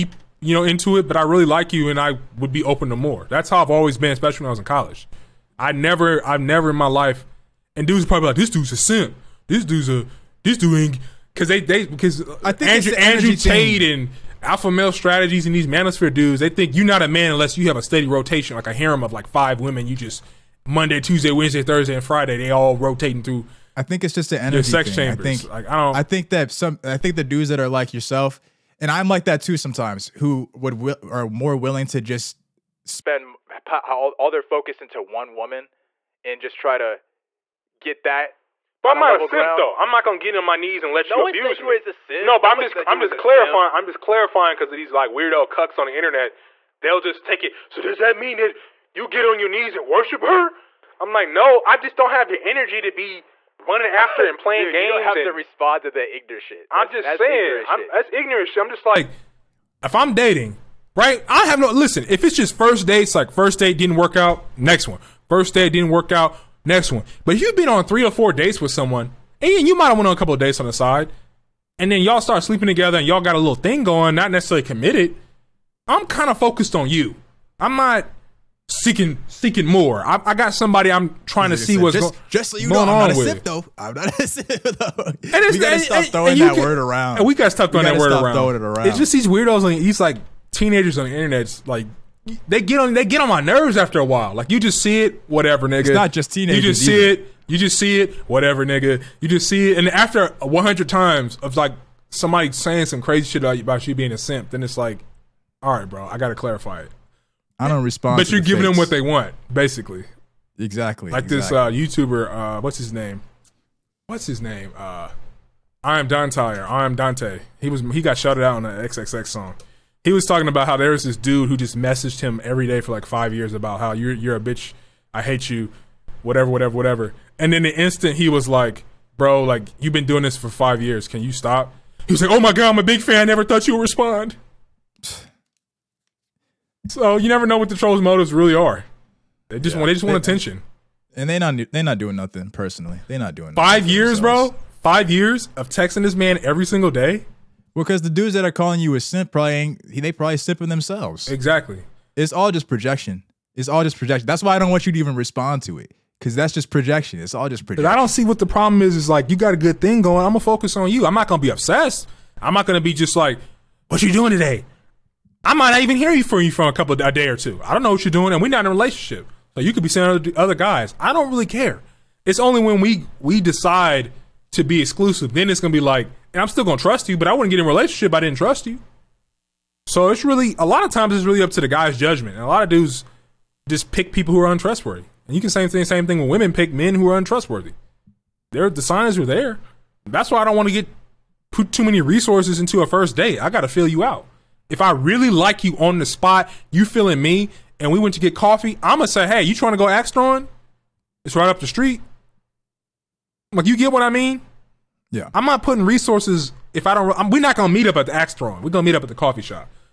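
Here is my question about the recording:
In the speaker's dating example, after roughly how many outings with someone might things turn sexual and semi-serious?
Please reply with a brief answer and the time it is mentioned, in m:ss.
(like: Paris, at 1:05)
3 or 4, at 1:07.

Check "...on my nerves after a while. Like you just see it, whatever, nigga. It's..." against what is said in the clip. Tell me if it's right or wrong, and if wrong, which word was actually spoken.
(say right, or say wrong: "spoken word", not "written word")
right.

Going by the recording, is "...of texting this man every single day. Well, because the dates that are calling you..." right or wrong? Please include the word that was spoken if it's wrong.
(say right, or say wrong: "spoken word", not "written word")
wrong: "dudes", not "dates".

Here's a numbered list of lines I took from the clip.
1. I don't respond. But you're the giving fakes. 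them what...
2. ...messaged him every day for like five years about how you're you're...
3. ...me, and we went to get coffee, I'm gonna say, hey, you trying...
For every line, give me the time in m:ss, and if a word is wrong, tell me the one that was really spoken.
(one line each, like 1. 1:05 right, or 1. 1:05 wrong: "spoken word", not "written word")
1. 1:47 right
2. 2:01 right
3. 3:17 right.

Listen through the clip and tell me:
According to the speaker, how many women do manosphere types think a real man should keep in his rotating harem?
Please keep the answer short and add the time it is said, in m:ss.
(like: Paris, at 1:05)
5, at 0:19.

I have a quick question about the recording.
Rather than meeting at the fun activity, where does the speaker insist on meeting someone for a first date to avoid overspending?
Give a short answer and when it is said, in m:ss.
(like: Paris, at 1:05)
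The coffee shop, at 3:29.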